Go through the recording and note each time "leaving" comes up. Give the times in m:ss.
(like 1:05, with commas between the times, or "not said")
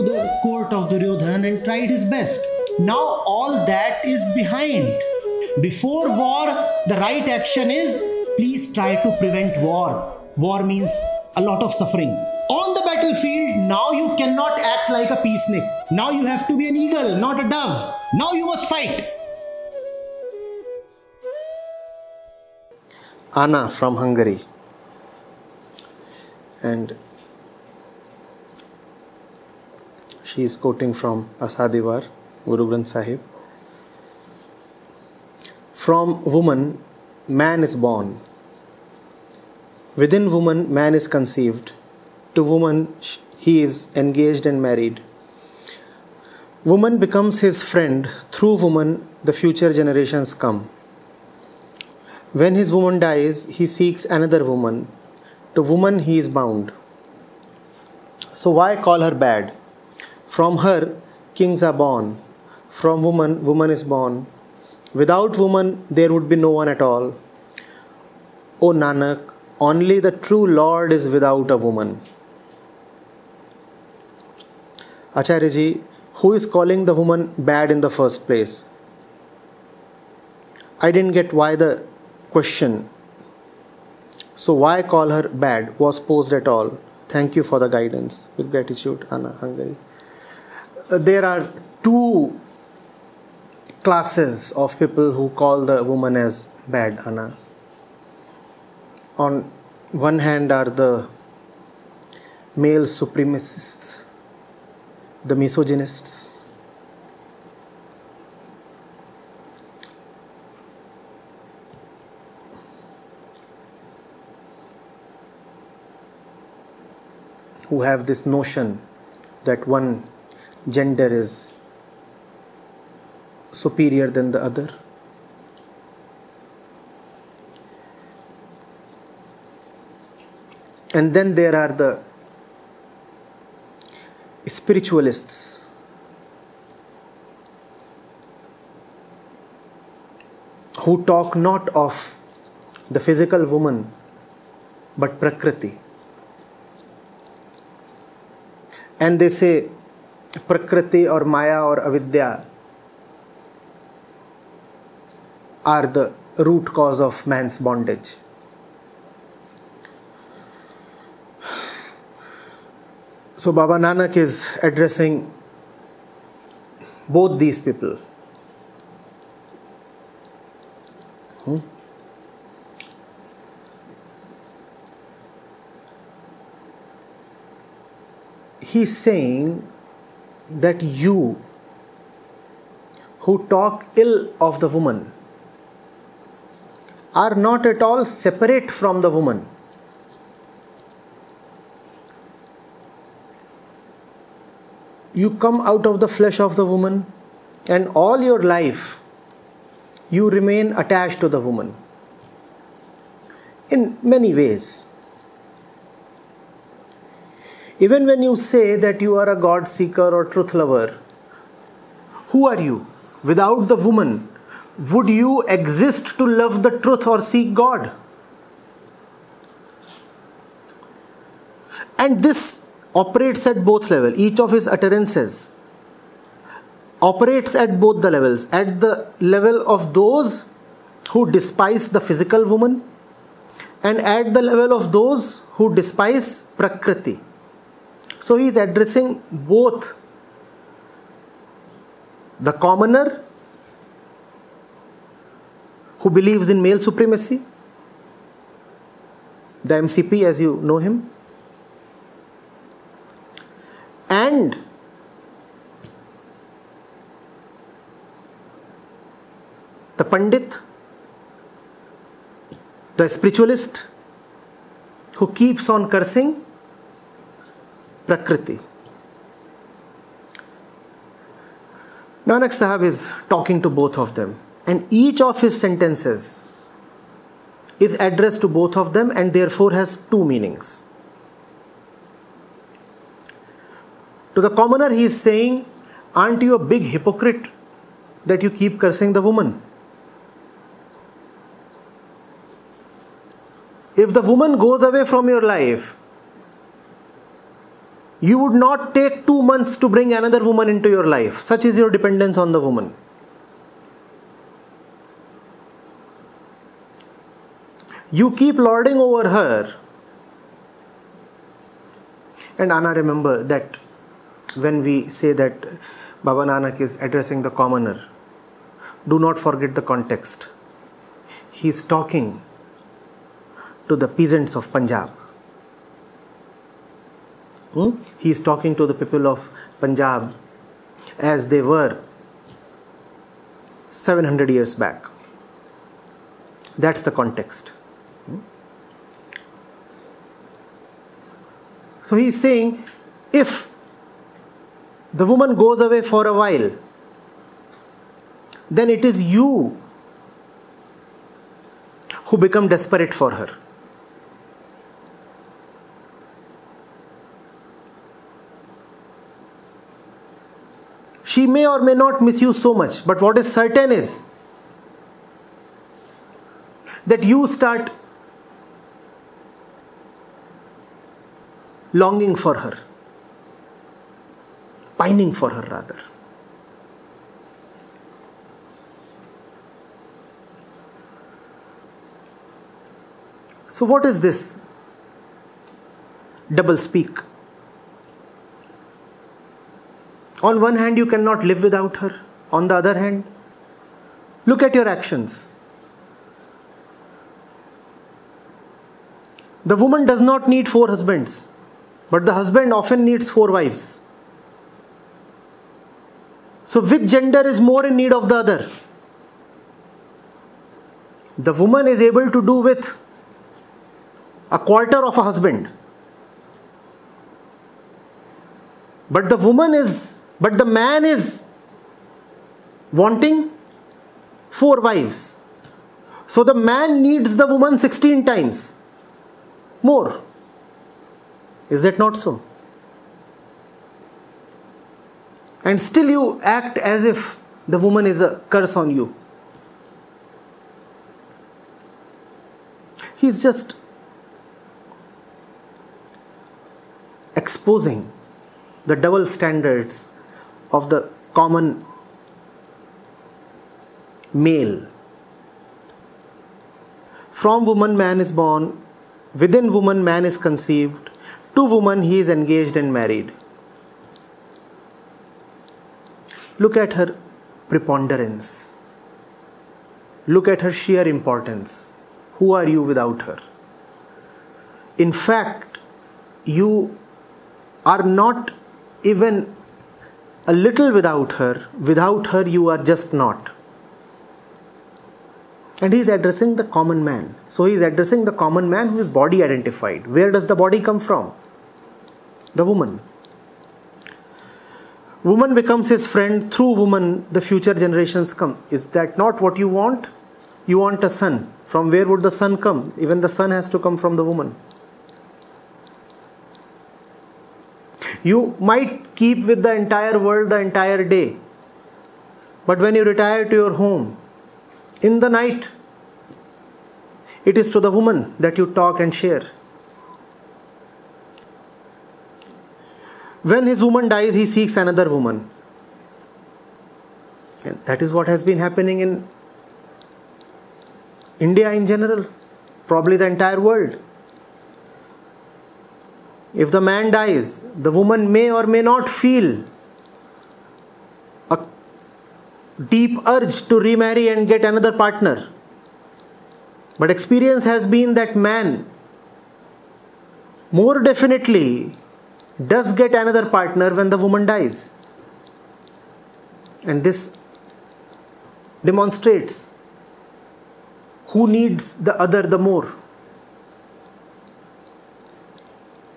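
not said.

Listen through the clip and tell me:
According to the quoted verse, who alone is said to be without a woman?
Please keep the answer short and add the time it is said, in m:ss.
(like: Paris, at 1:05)
the true Lord, at 1:09.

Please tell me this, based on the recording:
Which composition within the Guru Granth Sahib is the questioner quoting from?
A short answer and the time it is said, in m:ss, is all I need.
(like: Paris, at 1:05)
Asa di Vaar, at 0:31.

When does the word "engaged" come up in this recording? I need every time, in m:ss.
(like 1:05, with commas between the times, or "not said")
0:43, 7:42.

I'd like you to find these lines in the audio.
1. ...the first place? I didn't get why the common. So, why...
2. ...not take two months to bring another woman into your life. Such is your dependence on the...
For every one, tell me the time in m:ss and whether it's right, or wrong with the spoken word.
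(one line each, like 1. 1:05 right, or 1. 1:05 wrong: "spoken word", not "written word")
1. 1:17 wrong: "question", not "common"
2. 4:58 right.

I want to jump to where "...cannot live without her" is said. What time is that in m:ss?
6:31.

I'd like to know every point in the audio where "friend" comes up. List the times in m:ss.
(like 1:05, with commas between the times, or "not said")
0:47, 8:16.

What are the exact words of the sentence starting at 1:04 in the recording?
Without woman, there would be no one at all.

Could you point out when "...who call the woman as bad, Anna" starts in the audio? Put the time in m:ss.
1:35.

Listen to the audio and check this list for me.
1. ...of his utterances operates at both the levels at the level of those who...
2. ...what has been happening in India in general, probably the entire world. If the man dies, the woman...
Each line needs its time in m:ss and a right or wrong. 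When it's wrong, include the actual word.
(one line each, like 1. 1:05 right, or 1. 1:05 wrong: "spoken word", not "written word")
1. 3:44 right
2. 8:48 right.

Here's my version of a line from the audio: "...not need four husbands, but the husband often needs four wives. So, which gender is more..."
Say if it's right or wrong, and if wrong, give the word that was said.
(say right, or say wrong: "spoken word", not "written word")
right.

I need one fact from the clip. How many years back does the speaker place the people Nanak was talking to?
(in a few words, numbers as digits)
700.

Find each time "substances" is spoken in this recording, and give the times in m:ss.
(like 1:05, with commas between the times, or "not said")
not said.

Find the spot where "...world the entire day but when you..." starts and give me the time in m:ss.
8:30.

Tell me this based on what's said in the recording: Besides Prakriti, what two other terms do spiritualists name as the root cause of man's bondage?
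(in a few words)
Maya or Avidya.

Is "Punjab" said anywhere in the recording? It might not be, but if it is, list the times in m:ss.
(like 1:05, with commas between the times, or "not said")
5:24, 5:29.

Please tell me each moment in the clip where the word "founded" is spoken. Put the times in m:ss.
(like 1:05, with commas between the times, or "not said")
not said.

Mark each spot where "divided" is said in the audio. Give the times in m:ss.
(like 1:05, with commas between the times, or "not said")
not said.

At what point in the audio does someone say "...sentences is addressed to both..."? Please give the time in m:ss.
4:35.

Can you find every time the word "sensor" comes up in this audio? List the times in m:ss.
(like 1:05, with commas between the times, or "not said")
not said.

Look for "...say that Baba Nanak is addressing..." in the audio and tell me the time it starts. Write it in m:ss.
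5:15.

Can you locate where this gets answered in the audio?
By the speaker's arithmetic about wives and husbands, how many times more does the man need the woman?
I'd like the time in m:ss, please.
7:07.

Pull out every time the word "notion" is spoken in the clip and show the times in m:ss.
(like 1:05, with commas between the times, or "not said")
1:58.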